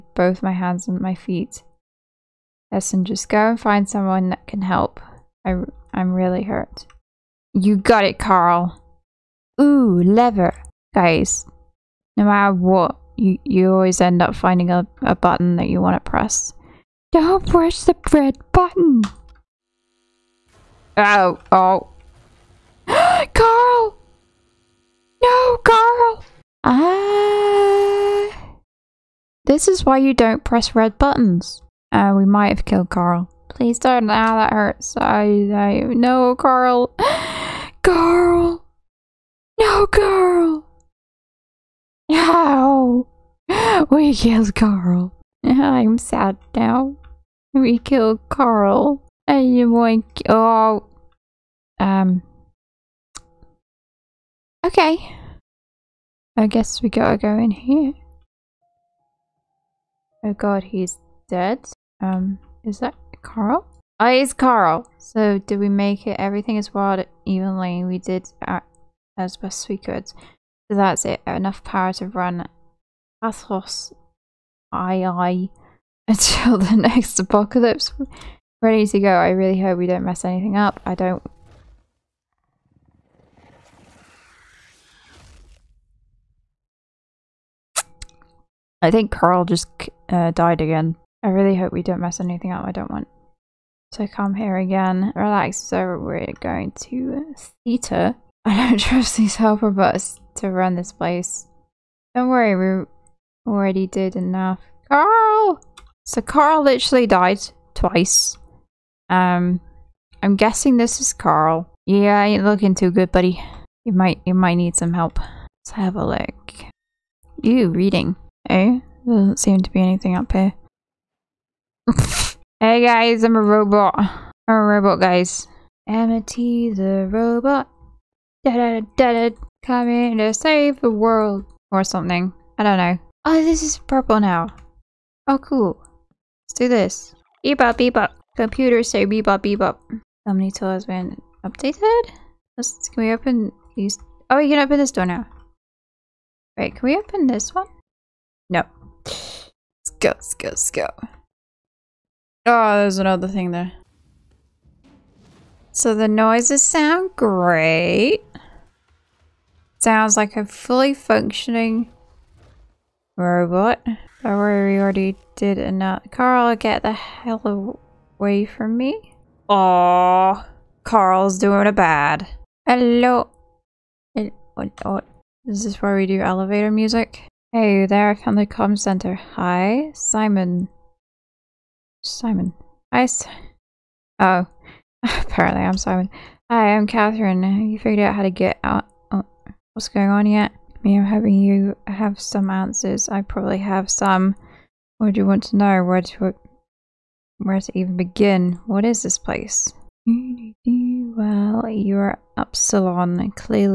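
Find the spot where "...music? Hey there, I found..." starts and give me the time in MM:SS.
02:56.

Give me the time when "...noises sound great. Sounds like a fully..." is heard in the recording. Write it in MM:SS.
02:36.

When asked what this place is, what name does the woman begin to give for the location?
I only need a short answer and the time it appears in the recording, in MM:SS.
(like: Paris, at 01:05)
Upsilon, at 03:22.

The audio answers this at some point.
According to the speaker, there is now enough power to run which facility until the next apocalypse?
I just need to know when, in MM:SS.
01:13.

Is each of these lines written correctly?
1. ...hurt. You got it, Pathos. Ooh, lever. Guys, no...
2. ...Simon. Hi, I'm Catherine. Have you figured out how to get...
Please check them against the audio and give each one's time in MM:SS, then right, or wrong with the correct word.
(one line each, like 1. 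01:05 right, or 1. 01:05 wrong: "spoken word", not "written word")
1. 00:06 wrong: "Carl", not "Pathos"
2. 03:05 right.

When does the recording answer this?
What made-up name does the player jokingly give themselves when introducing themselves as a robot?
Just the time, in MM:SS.
02:05.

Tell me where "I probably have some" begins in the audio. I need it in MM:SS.
03:13.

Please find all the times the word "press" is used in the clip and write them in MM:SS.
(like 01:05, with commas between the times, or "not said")
00:16, 00:30.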